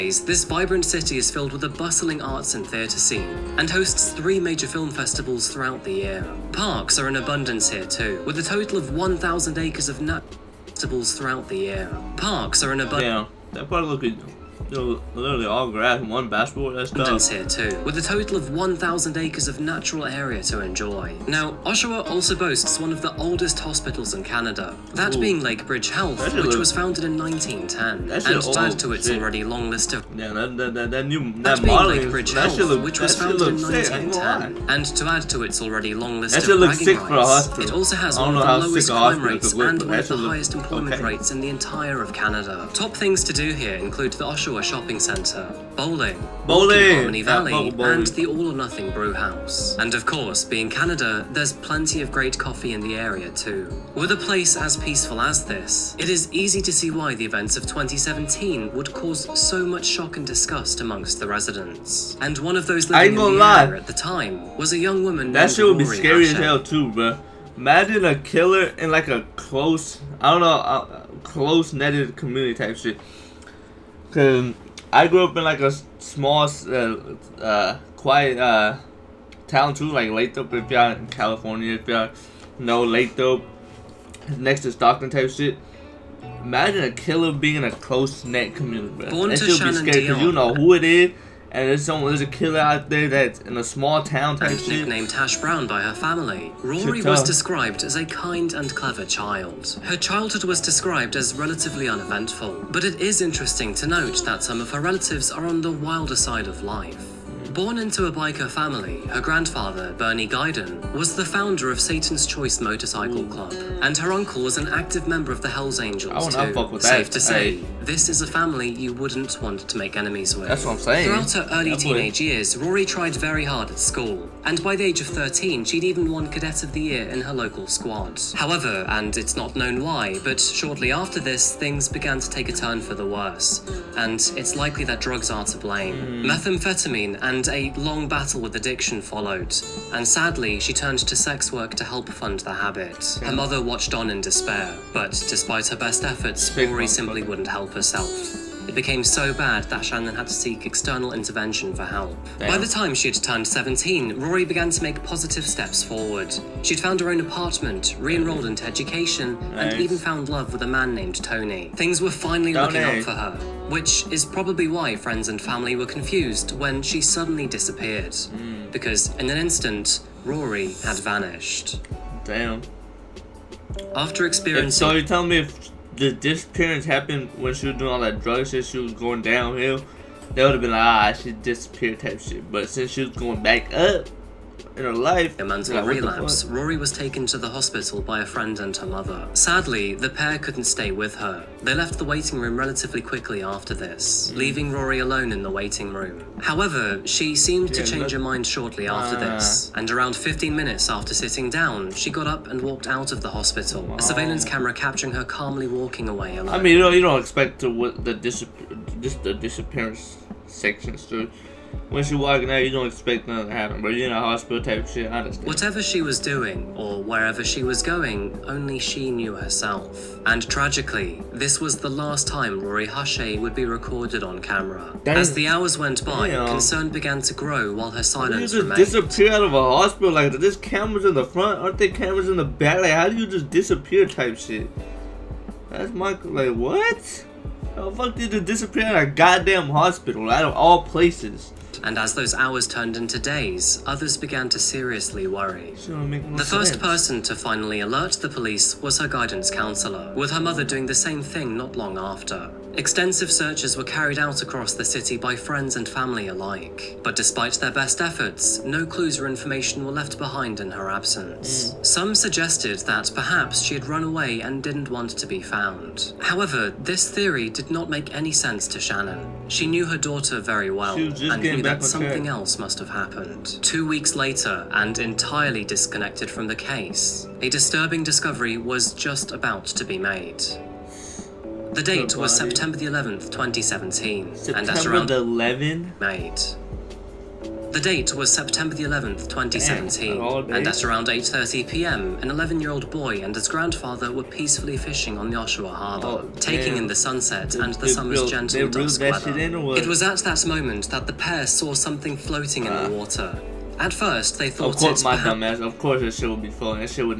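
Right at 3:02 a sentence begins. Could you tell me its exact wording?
But since she was going back up, in her life.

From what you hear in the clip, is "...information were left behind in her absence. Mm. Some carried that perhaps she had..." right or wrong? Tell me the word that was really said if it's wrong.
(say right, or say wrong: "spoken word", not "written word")
wrong: "suggested", not "carried".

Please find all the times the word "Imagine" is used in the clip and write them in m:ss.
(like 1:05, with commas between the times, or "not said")
1:07, 1:26.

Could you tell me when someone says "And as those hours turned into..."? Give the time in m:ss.
4:01.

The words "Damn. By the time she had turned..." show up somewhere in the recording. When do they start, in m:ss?
2:32.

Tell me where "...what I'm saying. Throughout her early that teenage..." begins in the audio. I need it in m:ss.
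2:00.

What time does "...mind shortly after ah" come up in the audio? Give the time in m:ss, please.
3:18.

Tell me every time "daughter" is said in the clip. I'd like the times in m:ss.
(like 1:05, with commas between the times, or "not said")
4:29.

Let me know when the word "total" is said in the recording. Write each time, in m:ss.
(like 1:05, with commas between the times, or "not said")
0:08, 0:18.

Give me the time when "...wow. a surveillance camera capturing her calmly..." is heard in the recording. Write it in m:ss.
3:23.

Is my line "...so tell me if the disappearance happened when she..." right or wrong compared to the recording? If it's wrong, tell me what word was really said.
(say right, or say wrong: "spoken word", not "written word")
right.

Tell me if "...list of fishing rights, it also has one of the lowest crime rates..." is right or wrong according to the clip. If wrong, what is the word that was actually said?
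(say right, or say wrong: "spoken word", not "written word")
wrong: "bragging", not "fishing".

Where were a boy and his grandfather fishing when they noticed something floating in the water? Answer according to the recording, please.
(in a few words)
Oshawa Harbour.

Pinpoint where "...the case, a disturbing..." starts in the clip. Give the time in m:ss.
4:36.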